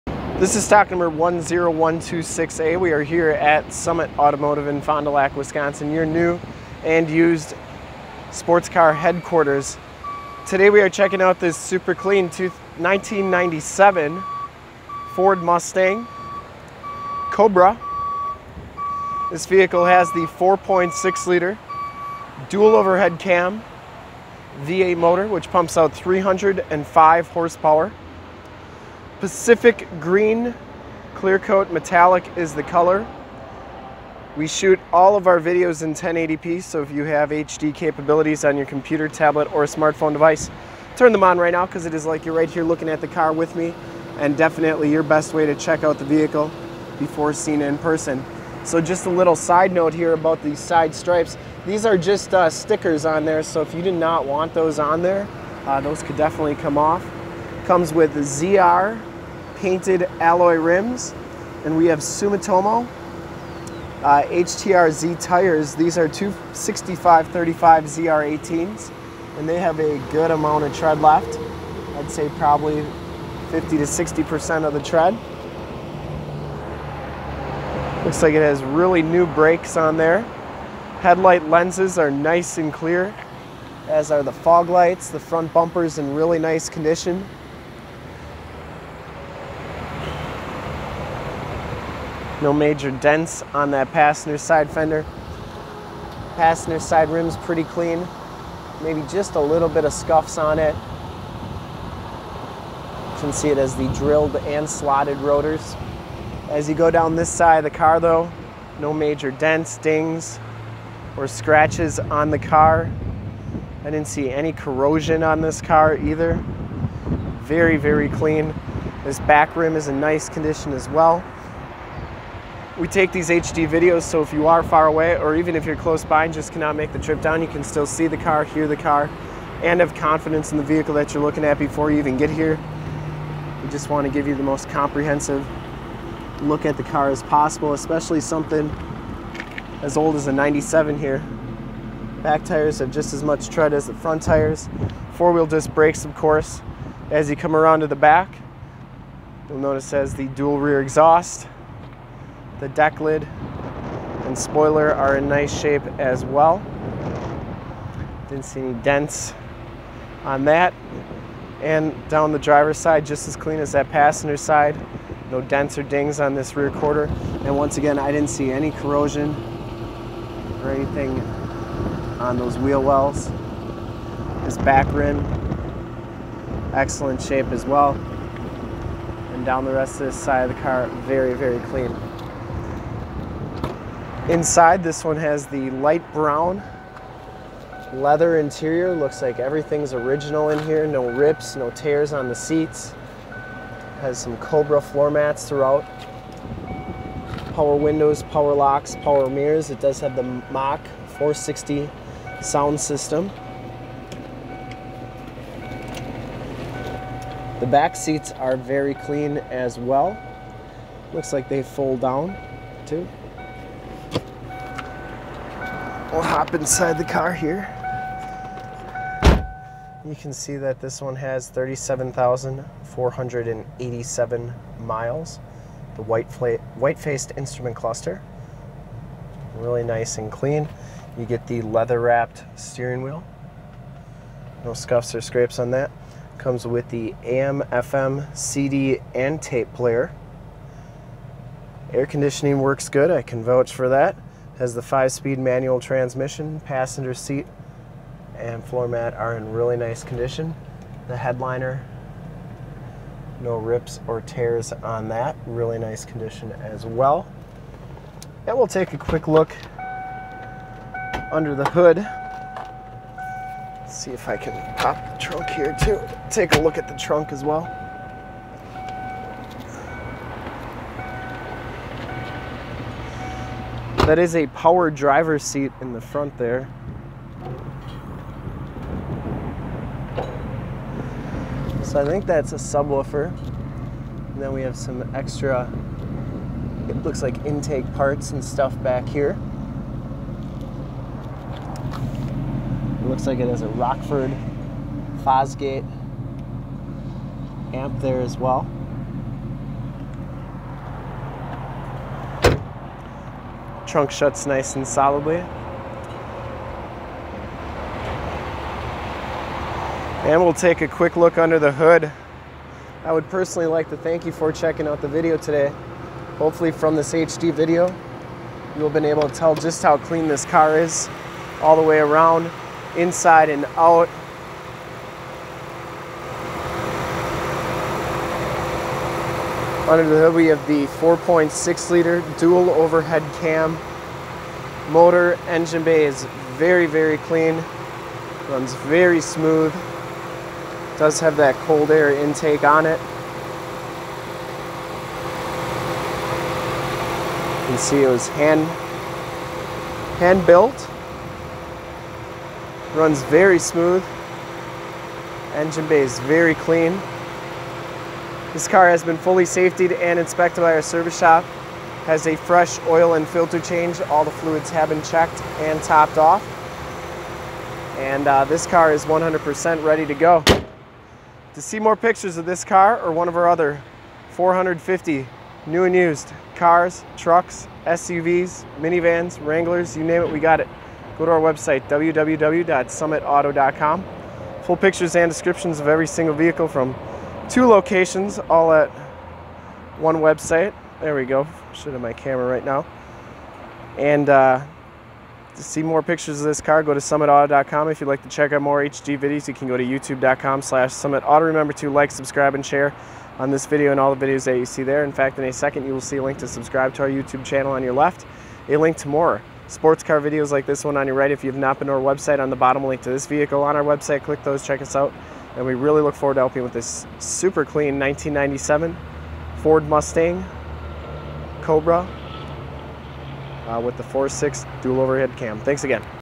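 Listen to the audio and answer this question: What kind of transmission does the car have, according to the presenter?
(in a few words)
five-speed manual.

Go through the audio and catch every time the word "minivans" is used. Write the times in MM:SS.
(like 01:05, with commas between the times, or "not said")
06:18.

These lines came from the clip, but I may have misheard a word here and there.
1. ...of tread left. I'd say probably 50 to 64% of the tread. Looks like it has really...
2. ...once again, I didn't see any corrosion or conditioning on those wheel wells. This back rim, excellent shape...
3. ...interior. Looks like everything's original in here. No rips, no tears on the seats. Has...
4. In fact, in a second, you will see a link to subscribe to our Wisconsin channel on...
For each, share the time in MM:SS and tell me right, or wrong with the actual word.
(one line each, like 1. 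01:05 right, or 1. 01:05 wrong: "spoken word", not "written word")
1. 01:10 wrong: "60", not "64"
2. 02:47 wrong: "anything", not "conditioning"
3. 03:08 right
4. 06:45 wrong: "YouTube", not "Wisconsin".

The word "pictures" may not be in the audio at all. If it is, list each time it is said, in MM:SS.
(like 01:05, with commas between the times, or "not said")
06:11, 06:24, 06:36.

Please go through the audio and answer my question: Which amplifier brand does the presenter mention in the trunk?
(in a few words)
Rockford Fosgate.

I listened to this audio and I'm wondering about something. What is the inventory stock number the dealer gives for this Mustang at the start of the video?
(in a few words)
10126A.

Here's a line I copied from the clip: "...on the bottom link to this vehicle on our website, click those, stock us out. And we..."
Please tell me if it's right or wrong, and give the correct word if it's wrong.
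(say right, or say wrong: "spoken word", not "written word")
wrong: "check", not "stock".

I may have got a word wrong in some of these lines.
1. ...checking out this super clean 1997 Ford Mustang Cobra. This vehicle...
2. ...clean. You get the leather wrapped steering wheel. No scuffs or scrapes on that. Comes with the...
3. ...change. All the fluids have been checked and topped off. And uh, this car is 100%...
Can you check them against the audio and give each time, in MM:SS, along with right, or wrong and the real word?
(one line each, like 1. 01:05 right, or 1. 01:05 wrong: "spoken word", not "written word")
1. 00:10 right
2. 03:50 right
3. 06:03 right.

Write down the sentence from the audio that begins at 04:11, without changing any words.
The headliner, no rips or tears on that, really nice condition as well.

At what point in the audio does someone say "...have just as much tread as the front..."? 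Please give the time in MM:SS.
02:22.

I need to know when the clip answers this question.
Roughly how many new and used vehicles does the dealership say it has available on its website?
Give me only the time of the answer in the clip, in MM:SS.
06:14.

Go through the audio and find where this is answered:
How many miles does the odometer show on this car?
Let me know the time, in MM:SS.
03:41.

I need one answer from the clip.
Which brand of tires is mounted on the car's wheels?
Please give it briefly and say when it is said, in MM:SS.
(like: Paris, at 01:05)
Sumitomo, at 01:01.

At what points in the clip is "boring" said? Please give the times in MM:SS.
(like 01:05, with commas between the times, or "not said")
not said.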